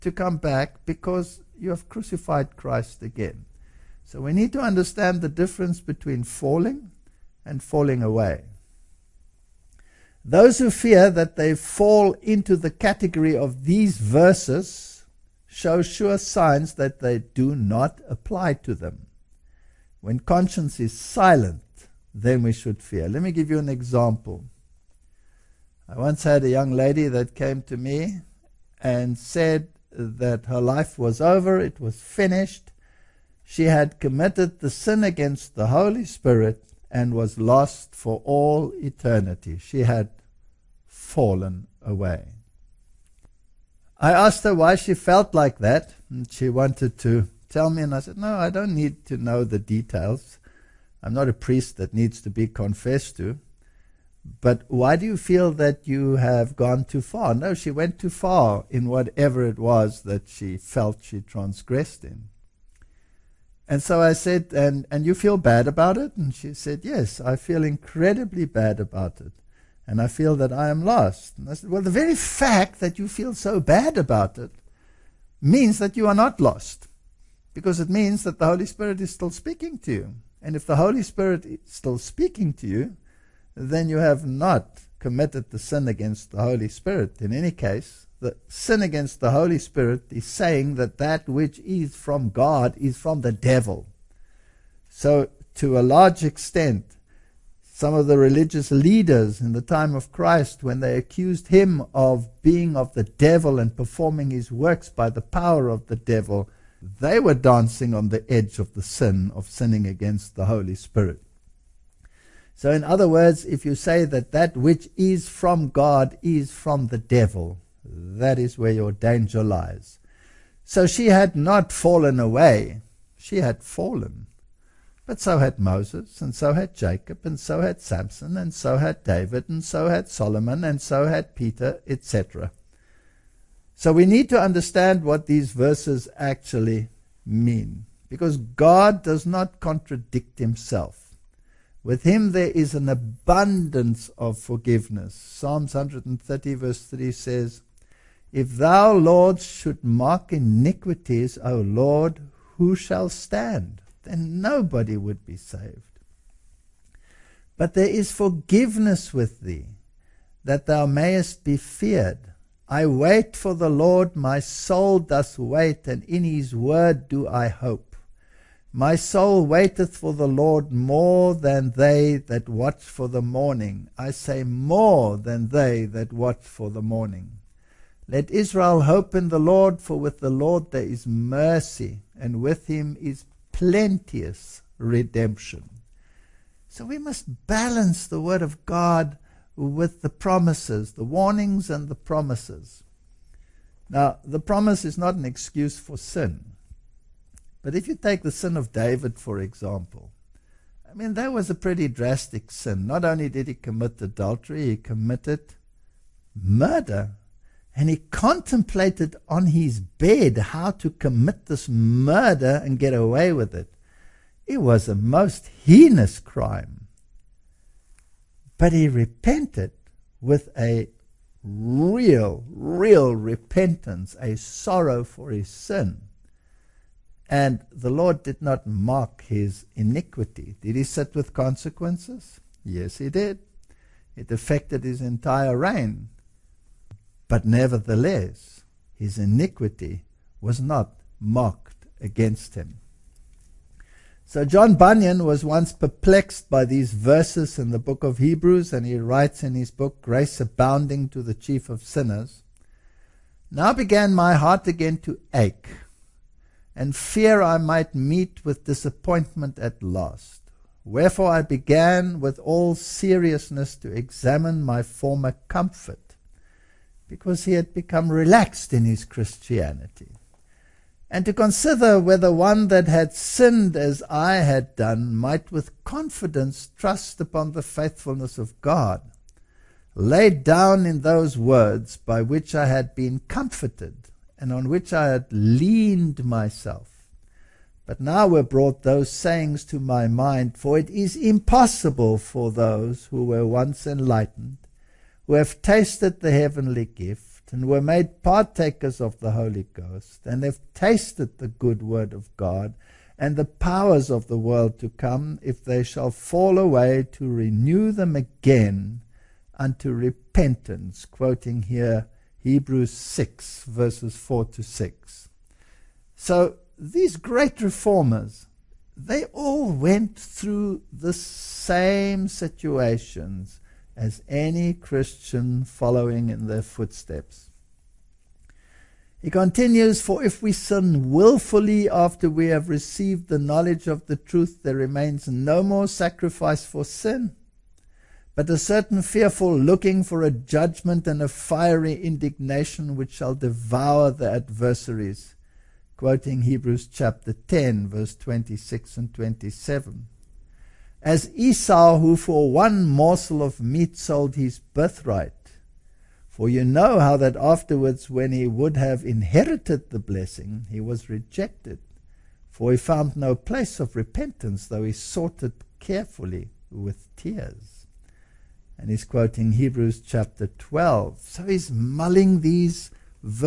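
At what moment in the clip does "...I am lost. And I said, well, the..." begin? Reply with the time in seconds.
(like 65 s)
70 s.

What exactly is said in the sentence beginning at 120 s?
So she had not fallen away, she had fallen.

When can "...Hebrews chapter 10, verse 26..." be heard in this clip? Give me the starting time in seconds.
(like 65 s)
346 s.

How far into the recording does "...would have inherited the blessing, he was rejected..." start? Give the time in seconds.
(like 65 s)
358 s.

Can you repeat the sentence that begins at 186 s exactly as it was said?
So we must balance the Word of God with the promises, the warnings and the promises.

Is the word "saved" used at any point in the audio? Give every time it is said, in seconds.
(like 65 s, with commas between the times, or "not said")
155 s.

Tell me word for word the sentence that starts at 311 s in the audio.
Quoting here Hebrews 6, verses 4 to 6.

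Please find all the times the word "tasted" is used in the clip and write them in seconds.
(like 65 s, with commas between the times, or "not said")
295 s, 300 s.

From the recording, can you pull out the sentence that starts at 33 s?
She had committed the sin against the Holy Spirit and was lost for all eternity.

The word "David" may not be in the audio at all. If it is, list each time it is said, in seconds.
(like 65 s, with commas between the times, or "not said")
129 s, 198 s.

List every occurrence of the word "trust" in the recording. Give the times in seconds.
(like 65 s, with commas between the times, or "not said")
276 s.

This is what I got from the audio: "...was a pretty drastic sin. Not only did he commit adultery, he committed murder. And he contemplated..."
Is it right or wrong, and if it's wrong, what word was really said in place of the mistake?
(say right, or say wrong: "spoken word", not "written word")
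right.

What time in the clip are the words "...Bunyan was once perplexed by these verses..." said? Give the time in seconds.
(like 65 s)
244 s.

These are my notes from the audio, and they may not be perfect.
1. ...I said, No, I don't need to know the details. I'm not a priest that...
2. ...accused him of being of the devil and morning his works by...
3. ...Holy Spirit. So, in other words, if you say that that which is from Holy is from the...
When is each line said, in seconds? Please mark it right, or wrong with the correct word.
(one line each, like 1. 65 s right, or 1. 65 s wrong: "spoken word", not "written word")
1. 47 s right
2. 100 s wrong: "performing", not "morning"
3. 110 s wrong: "God", not "Holy".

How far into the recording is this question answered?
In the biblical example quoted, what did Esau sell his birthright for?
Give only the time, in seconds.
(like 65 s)
352 s.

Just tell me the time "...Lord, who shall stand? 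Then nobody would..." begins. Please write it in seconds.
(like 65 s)
151 s.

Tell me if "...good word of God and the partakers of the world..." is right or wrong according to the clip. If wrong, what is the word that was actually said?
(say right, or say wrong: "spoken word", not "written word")
wrong: "powers", not "partakers".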